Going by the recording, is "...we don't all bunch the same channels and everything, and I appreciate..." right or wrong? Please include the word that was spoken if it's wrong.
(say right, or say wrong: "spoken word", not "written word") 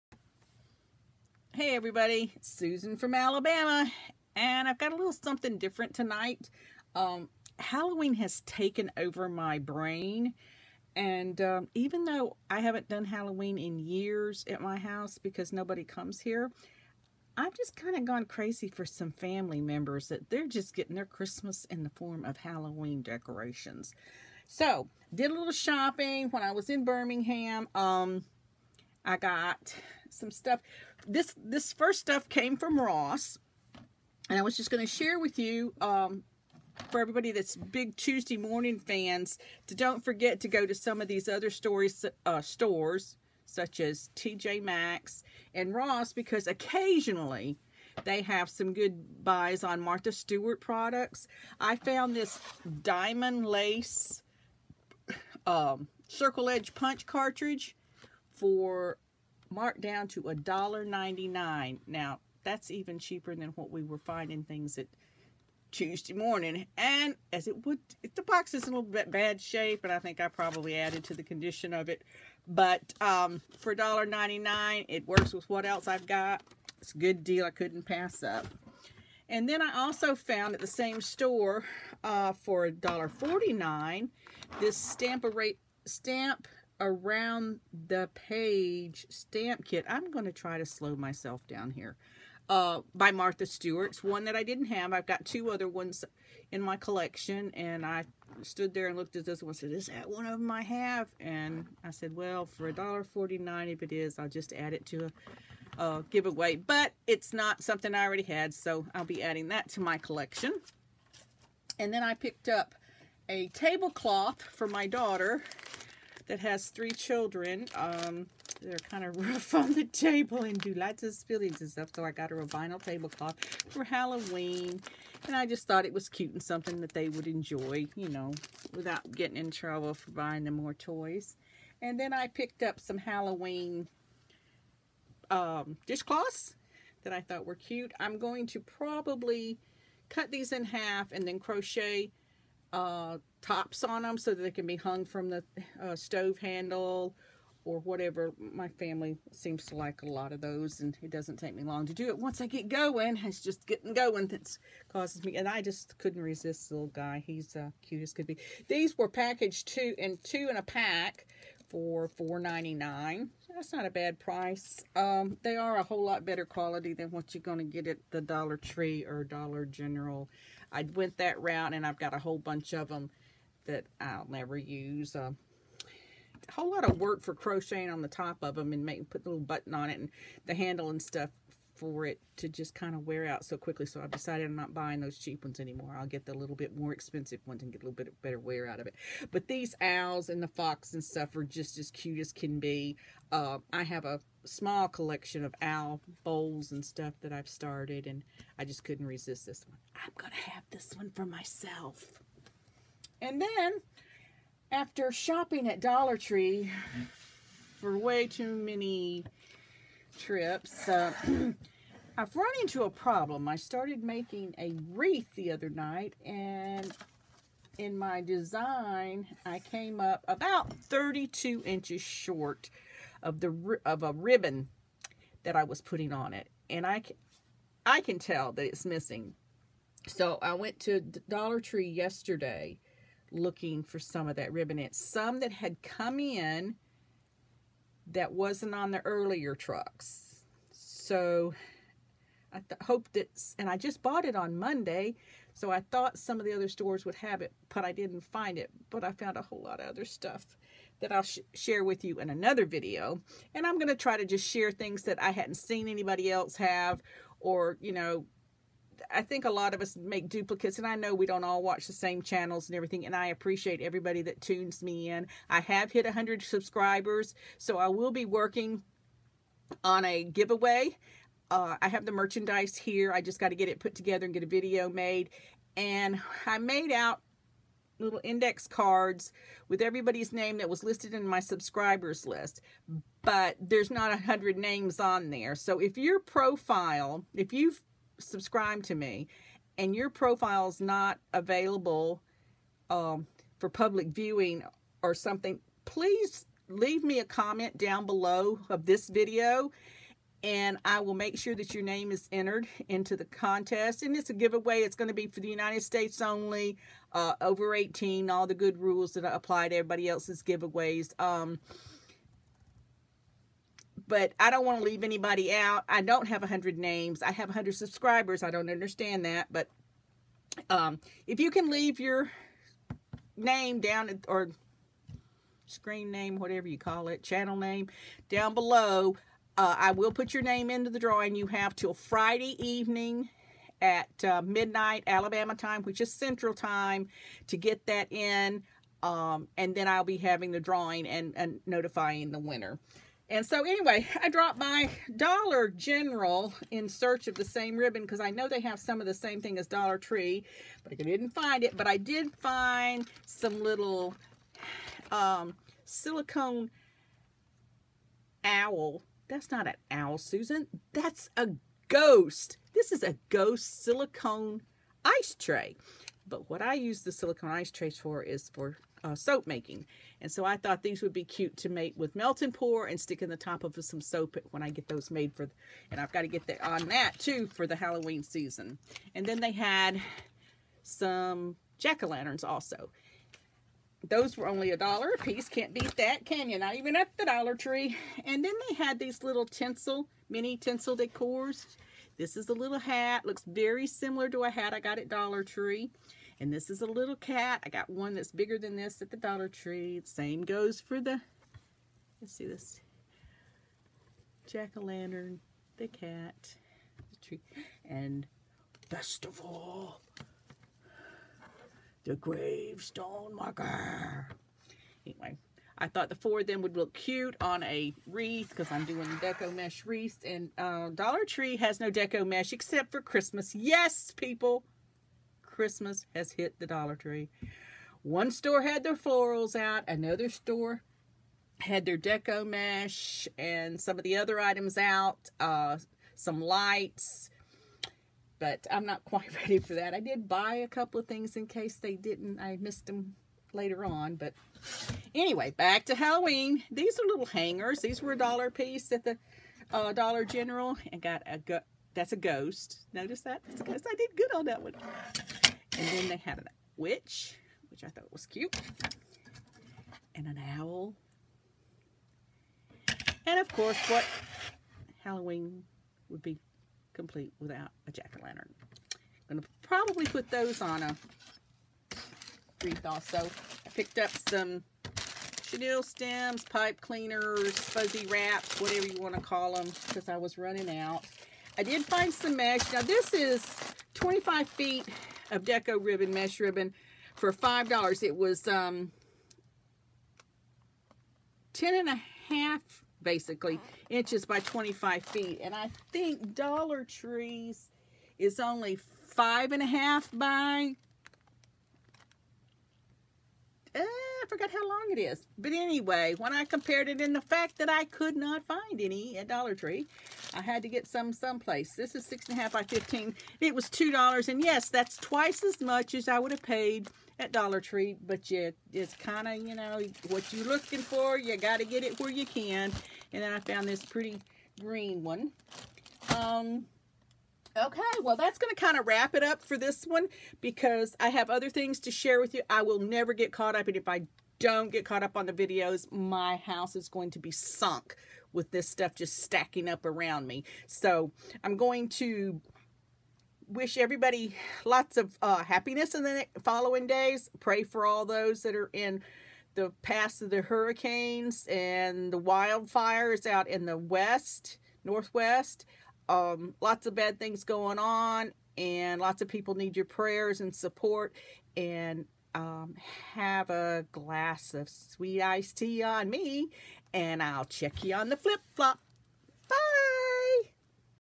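wrong: "watch", not "bunch".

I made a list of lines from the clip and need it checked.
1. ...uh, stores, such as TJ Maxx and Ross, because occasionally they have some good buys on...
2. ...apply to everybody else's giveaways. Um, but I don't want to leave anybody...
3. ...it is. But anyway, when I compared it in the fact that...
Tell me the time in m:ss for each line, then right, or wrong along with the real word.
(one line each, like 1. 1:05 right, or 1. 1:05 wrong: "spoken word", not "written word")
1. 0:42 right
2. 5:09 right
3. 8:24 right.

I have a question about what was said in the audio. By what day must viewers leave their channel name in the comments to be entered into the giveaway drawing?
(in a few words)
Friday.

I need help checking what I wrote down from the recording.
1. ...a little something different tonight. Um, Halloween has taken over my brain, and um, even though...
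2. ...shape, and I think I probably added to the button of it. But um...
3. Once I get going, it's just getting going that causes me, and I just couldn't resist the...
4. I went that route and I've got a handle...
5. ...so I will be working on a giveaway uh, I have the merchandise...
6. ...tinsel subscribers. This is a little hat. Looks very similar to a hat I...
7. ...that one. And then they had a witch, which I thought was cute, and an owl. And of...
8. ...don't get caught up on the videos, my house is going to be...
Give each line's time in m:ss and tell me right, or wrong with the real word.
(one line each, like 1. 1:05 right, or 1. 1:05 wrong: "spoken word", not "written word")
1. 0:04 right
2. 1:09 wrong: "condition", not "button"
3. 2:32 right
4. 2:50 wrong: "whole", not "handle"
5. 4:27 right
6. 6:30 wrong: "decors", not "subscribers"
7. 7:34 right
8. 8:54 right.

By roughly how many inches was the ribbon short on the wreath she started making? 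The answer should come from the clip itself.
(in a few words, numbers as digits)
32 inches.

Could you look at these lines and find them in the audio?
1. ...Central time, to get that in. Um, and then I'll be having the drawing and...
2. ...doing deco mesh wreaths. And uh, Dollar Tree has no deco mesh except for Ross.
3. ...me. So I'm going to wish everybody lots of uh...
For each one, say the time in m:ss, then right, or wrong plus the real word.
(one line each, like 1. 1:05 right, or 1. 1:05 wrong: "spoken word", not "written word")
1. 5:36 right
2. 6:58 wrong: "Christmas", not "Ross"
3. 9:00 right.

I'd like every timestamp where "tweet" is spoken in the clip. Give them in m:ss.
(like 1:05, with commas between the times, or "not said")
not said.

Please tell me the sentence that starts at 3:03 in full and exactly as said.
So I've decided I'm not buying those cheap ones anymore.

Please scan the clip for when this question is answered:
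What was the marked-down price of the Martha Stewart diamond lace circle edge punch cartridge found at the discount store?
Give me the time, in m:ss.
1:00.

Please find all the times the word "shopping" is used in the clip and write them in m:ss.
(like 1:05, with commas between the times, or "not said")
0:25, 3:25.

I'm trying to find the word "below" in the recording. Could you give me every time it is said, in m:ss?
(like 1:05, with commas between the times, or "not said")
4:58, 5:28.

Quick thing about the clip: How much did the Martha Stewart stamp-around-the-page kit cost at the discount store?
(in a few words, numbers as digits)
$1.49.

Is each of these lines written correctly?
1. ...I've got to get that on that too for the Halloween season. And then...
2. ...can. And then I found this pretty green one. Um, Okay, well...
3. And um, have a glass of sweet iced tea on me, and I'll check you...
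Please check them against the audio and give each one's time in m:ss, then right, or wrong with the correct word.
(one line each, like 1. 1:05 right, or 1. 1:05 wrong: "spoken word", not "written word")
1. 6:16 right
2. 8:42 right
3. 9:21 right.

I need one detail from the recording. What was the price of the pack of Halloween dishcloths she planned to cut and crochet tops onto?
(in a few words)
$4.99.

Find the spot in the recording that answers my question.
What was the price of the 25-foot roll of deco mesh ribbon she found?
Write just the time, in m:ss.
8:07.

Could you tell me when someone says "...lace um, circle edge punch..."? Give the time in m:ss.
0:53.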